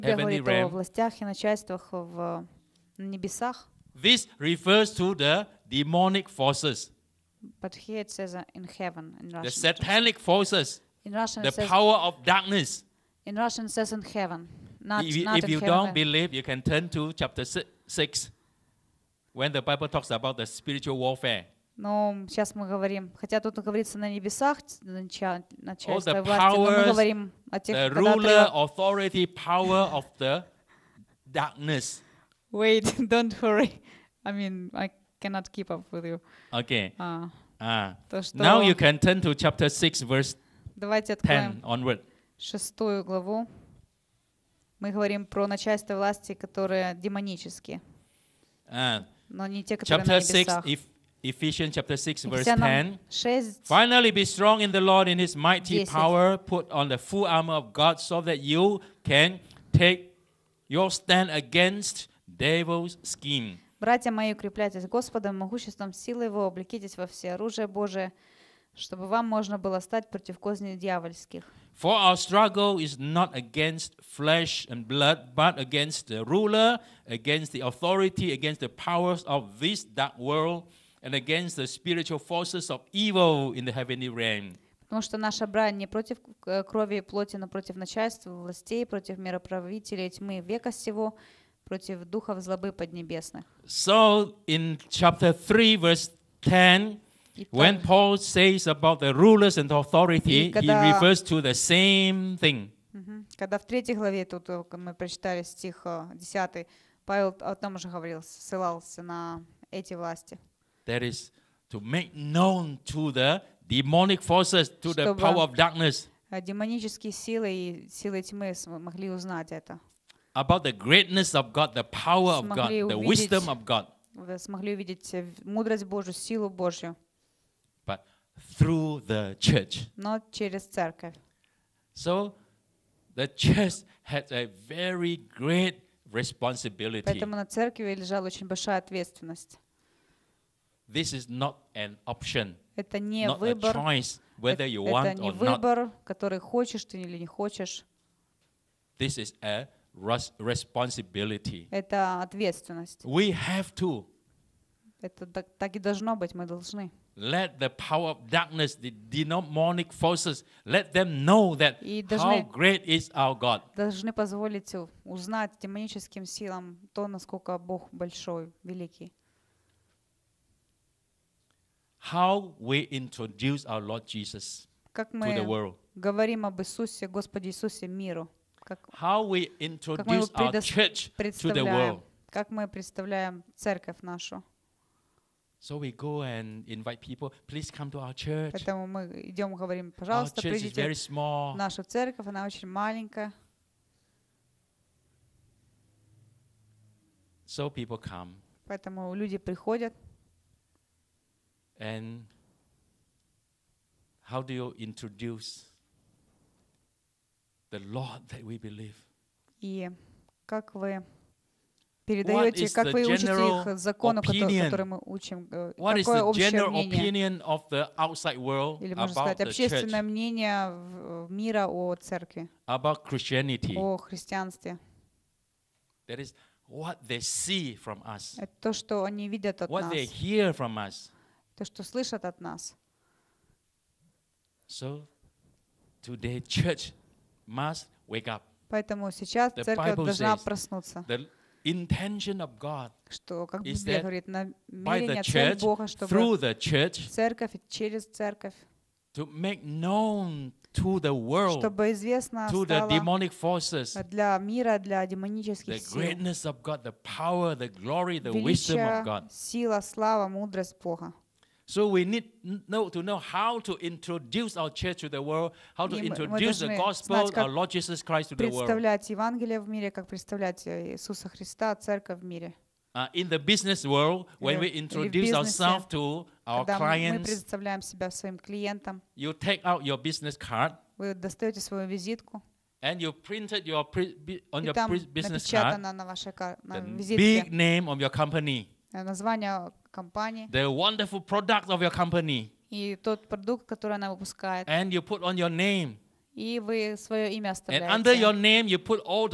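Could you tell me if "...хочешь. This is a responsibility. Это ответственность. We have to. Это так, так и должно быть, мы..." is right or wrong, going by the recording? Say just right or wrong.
right.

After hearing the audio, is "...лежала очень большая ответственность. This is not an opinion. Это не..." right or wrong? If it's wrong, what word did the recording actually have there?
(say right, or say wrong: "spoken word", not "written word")
wrong: "option", not "opinion".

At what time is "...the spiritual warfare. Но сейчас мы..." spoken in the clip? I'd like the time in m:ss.
0:20.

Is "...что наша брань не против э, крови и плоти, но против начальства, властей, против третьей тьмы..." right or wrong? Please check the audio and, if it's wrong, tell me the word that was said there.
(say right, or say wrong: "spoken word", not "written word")
wrong: "мироправителей", not "третьей".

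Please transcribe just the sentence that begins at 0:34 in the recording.
I mean, I cannot keep up with you.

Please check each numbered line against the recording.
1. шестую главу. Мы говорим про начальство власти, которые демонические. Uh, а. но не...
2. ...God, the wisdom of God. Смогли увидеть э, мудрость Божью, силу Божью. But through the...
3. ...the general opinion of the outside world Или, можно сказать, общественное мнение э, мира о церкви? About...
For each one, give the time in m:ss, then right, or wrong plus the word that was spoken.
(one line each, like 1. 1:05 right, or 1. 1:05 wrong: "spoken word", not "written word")
1. 0:42 right
2. 2:02 right
3. 3:36 right.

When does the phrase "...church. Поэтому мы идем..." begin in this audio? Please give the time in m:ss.
3:08.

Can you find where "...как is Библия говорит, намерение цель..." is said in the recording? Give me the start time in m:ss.
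4:03.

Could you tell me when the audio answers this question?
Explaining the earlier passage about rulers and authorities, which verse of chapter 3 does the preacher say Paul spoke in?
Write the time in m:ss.
1:34.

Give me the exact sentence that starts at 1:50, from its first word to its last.
that is to make known to the demonic forces, to the power of darkness.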